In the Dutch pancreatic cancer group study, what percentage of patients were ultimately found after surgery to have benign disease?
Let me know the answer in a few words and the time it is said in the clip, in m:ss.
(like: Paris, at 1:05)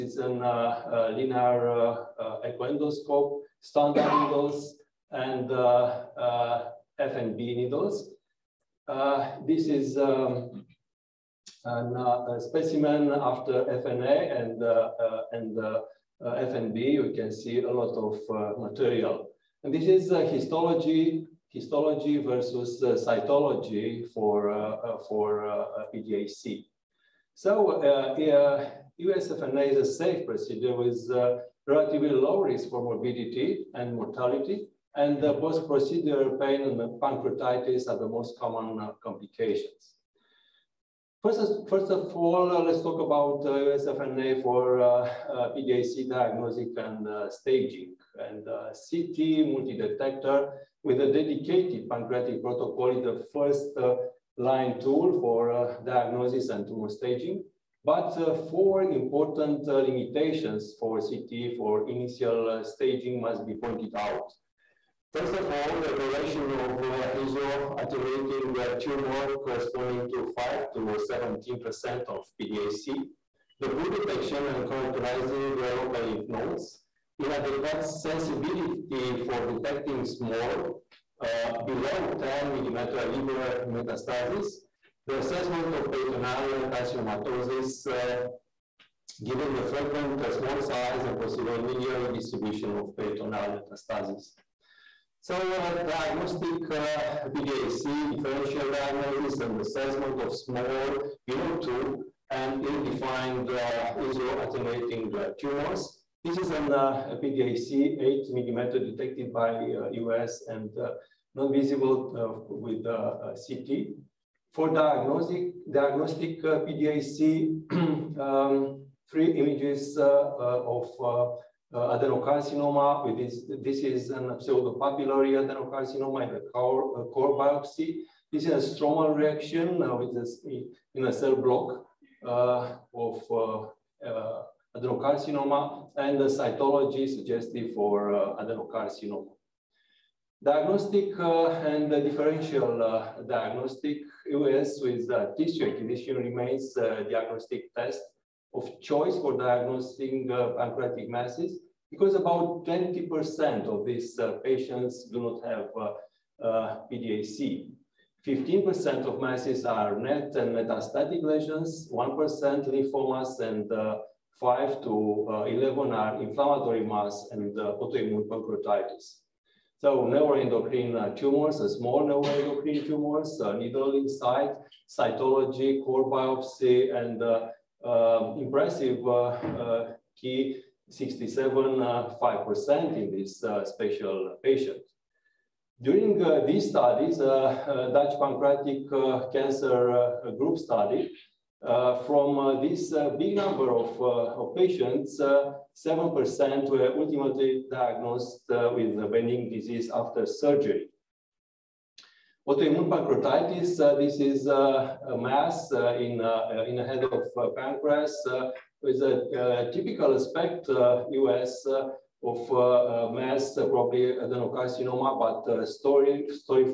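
7%, at 3:15.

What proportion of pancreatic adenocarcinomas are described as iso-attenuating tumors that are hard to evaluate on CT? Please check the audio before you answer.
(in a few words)
5 to 17%.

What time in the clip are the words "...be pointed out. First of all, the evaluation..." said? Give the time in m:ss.
1:03.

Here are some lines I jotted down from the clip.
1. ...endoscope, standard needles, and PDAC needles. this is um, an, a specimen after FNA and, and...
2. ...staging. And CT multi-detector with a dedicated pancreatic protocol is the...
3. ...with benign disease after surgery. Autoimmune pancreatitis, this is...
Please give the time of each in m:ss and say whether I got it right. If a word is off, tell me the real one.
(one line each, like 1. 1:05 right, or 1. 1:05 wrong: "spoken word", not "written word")
1. 0:02 wrong: "FNB", not "PDAC"
2. 0:47 right
3. 3:18 right.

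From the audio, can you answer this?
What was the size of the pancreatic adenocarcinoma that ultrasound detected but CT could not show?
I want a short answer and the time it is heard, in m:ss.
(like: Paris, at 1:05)
8 millimeters, at 1:47.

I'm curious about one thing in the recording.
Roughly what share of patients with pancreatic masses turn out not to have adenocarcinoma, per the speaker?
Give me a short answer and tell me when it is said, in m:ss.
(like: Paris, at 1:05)
20%, at 2:32.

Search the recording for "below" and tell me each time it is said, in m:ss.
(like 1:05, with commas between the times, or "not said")
1:21, 1:41.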